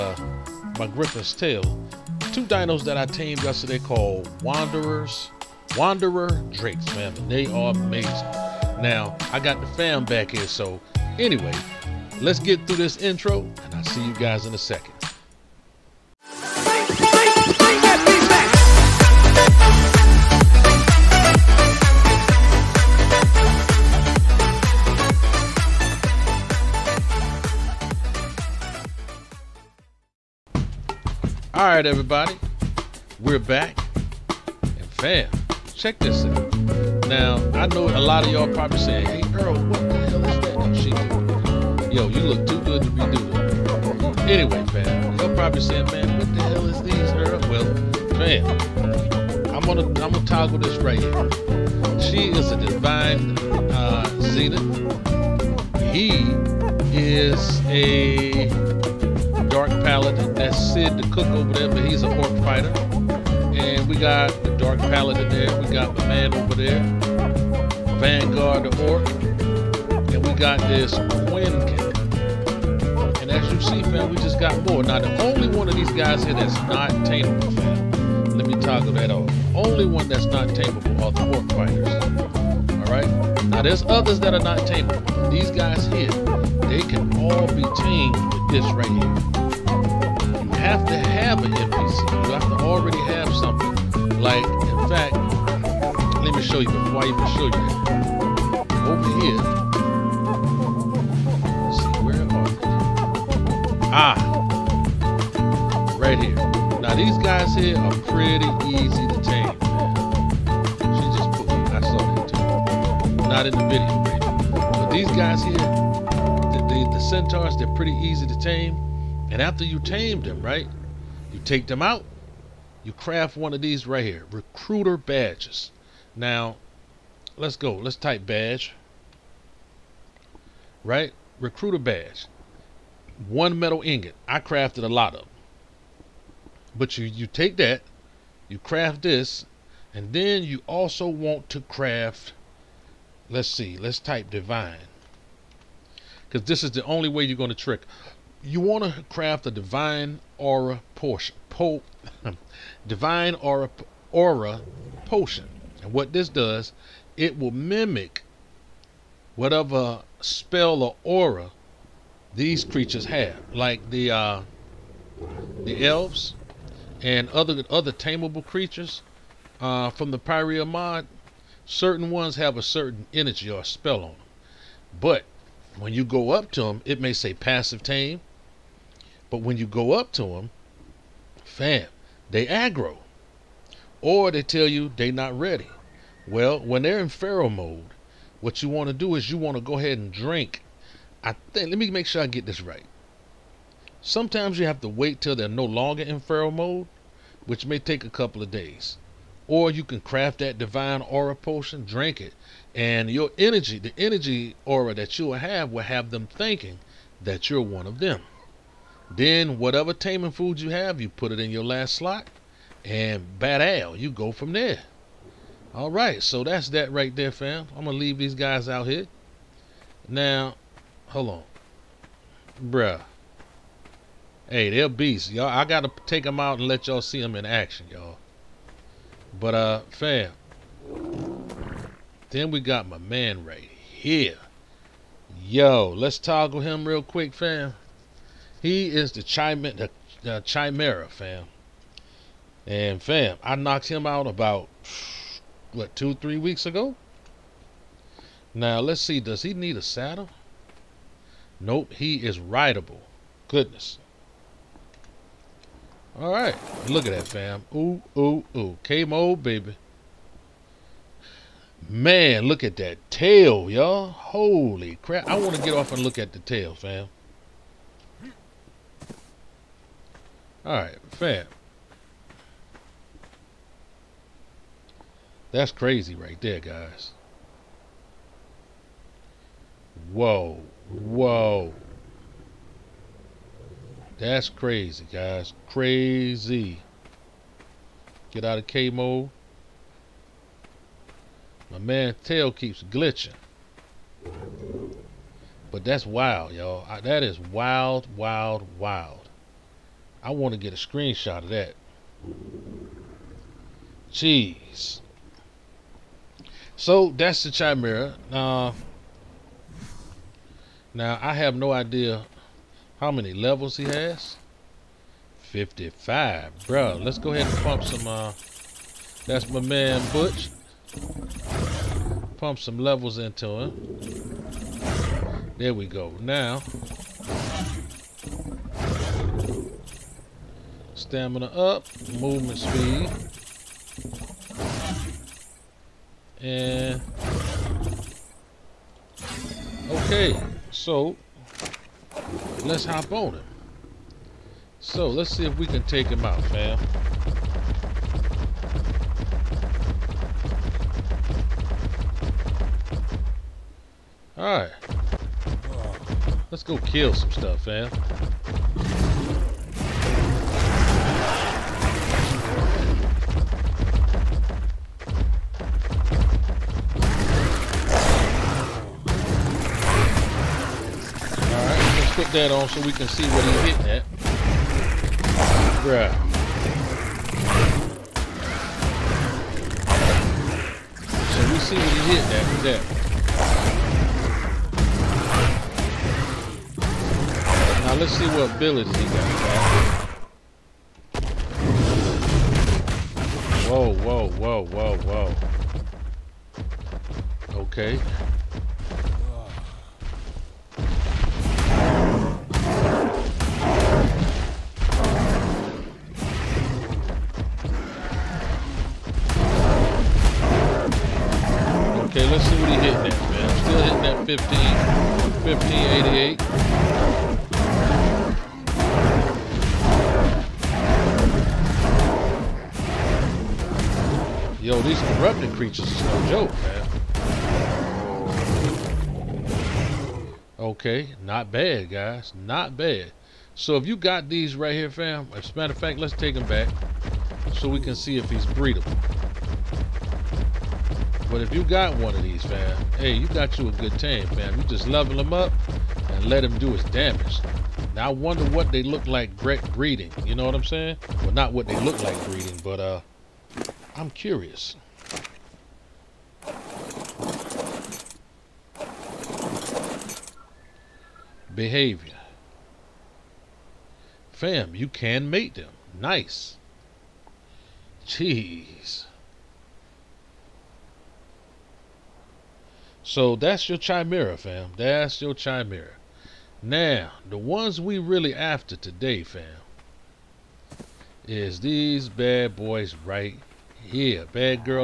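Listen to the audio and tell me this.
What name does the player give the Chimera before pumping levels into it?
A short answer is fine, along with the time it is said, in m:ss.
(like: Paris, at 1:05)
Butch, at 5:20.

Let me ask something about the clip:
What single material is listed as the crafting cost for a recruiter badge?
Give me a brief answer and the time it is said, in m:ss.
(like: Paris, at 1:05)
One metal ingot, at 2:13.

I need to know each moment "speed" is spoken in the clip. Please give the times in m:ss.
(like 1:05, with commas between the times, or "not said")
5:32.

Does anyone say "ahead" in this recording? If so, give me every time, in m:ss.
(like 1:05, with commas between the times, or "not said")
3:09, 5:17.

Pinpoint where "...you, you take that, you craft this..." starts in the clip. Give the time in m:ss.
2:16.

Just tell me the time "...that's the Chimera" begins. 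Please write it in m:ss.
5:07.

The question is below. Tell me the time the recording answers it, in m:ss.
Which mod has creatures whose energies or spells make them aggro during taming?
2:50.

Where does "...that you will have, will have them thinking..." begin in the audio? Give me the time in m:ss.
3:24.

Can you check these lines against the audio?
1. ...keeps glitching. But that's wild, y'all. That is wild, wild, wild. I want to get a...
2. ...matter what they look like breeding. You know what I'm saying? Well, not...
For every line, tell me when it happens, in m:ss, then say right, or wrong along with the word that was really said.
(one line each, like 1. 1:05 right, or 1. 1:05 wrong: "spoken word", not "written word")
1. 4:52 right
2. 7:28 wrong: "wonder", not "matter".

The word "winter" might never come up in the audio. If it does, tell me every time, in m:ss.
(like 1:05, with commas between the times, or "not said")
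not said.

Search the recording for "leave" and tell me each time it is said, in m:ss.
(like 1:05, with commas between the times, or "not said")
3:37.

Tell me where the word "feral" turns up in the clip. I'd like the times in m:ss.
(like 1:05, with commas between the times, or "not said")
3:07, 3:16.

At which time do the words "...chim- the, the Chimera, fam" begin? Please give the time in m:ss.
3:59.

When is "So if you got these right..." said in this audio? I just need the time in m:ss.
7:13.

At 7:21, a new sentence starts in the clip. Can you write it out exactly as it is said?
But if you got one of these, fam, hey, you got you a good tame, fam.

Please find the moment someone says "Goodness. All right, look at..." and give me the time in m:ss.
4:13.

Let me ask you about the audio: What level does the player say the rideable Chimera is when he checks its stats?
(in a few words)
55.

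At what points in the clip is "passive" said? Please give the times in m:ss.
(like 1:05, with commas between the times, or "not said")
2:57.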